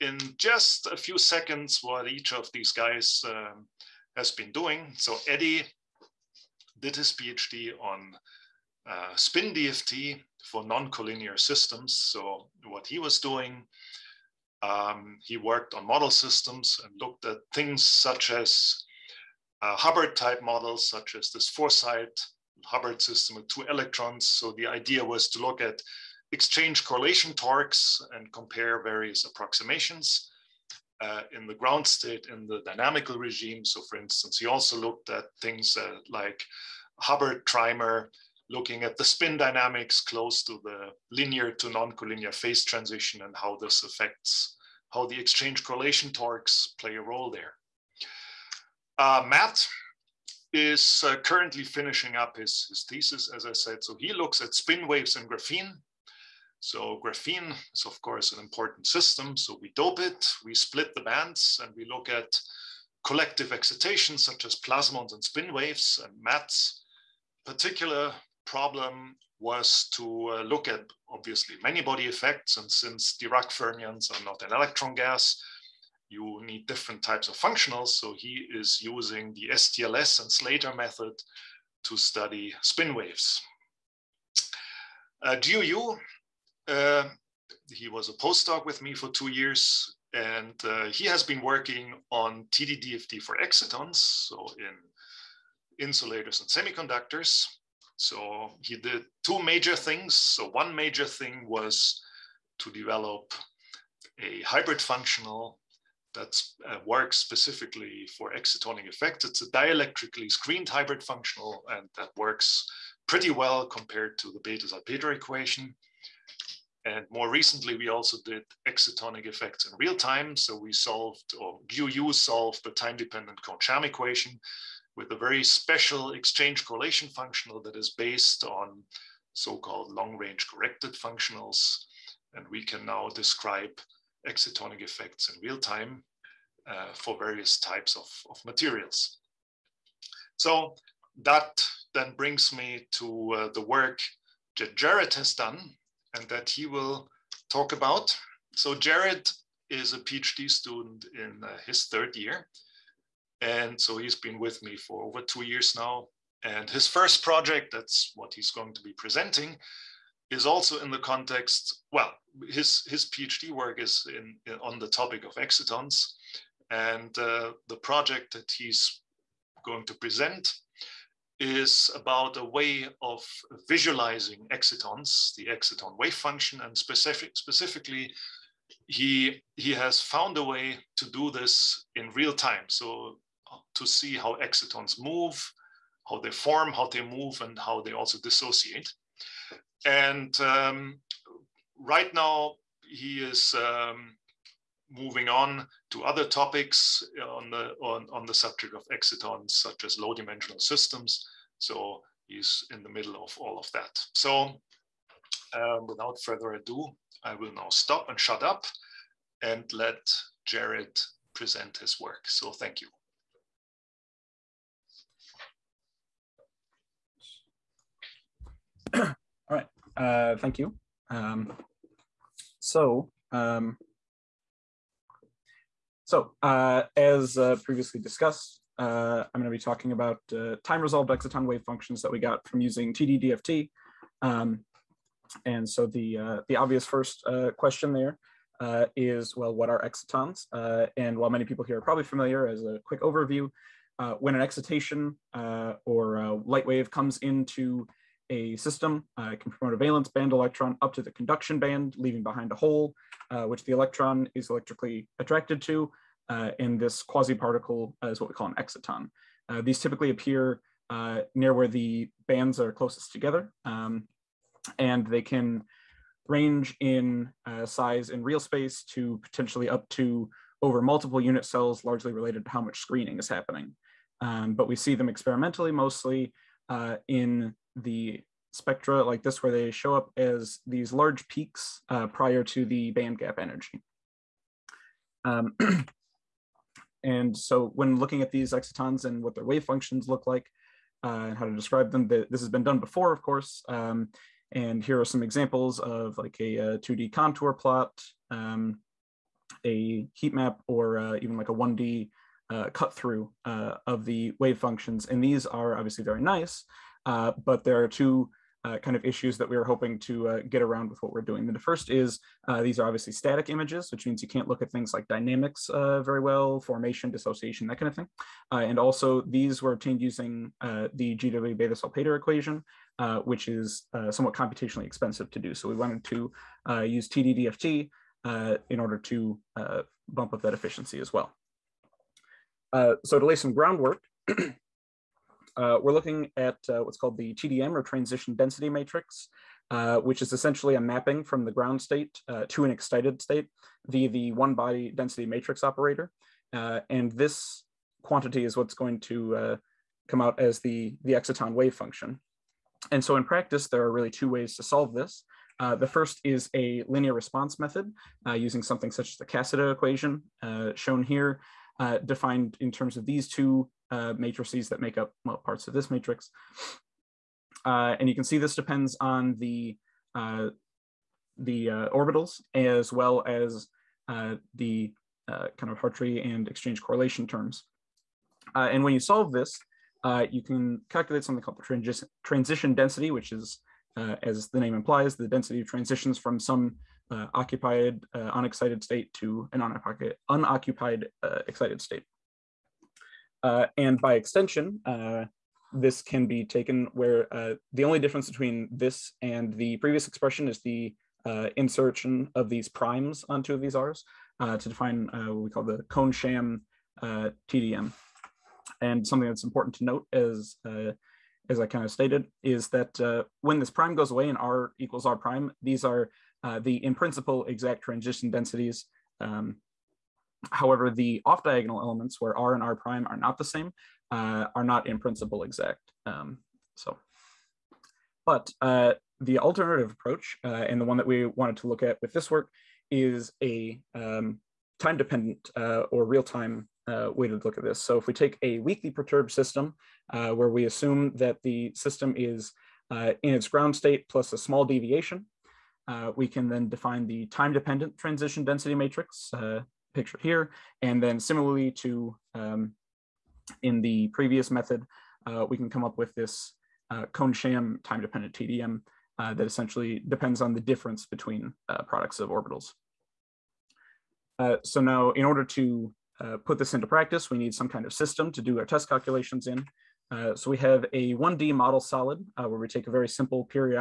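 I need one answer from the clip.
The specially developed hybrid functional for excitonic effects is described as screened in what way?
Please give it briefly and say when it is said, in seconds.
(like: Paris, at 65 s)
Dielectrically, at 109 s.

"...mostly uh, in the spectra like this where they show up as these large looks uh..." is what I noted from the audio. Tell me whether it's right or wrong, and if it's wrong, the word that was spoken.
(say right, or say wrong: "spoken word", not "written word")
wrong: "peaks", not "looks".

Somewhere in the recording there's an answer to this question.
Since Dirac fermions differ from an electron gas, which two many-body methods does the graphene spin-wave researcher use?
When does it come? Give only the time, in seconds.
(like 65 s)
79 s.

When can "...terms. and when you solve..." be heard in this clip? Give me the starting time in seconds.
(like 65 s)
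377 s.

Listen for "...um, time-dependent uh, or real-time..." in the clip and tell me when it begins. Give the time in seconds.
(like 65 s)
433 s.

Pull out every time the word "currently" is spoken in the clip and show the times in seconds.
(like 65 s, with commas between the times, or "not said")
51 s.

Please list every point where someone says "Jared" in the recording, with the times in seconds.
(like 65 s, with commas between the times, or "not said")
144 s, 148 s, 210 s.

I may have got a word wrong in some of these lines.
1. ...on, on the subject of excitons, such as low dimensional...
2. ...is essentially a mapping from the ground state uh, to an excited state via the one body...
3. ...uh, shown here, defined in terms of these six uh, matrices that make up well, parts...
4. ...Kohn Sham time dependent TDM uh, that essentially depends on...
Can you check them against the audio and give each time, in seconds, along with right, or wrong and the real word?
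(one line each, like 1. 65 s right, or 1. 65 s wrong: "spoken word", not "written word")
1. 197 s right
2. 340 s right
3. 360 s wrong: "two", not "six"
4. 457 s right.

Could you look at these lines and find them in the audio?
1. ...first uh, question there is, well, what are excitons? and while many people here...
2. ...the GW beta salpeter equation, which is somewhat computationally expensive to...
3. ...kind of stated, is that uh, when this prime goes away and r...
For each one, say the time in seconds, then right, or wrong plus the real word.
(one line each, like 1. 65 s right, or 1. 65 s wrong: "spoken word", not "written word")
1. 236 s right
2. 320 s right
3. 411 s right.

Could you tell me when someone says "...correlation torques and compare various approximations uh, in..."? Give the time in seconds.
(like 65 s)
26 s.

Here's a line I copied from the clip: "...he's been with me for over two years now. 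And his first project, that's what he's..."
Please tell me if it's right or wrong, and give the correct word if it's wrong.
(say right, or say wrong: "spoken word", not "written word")
right.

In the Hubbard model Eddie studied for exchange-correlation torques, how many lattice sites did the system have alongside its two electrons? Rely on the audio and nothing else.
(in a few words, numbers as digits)
4.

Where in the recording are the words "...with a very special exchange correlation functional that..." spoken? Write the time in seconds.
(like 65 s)
124 s.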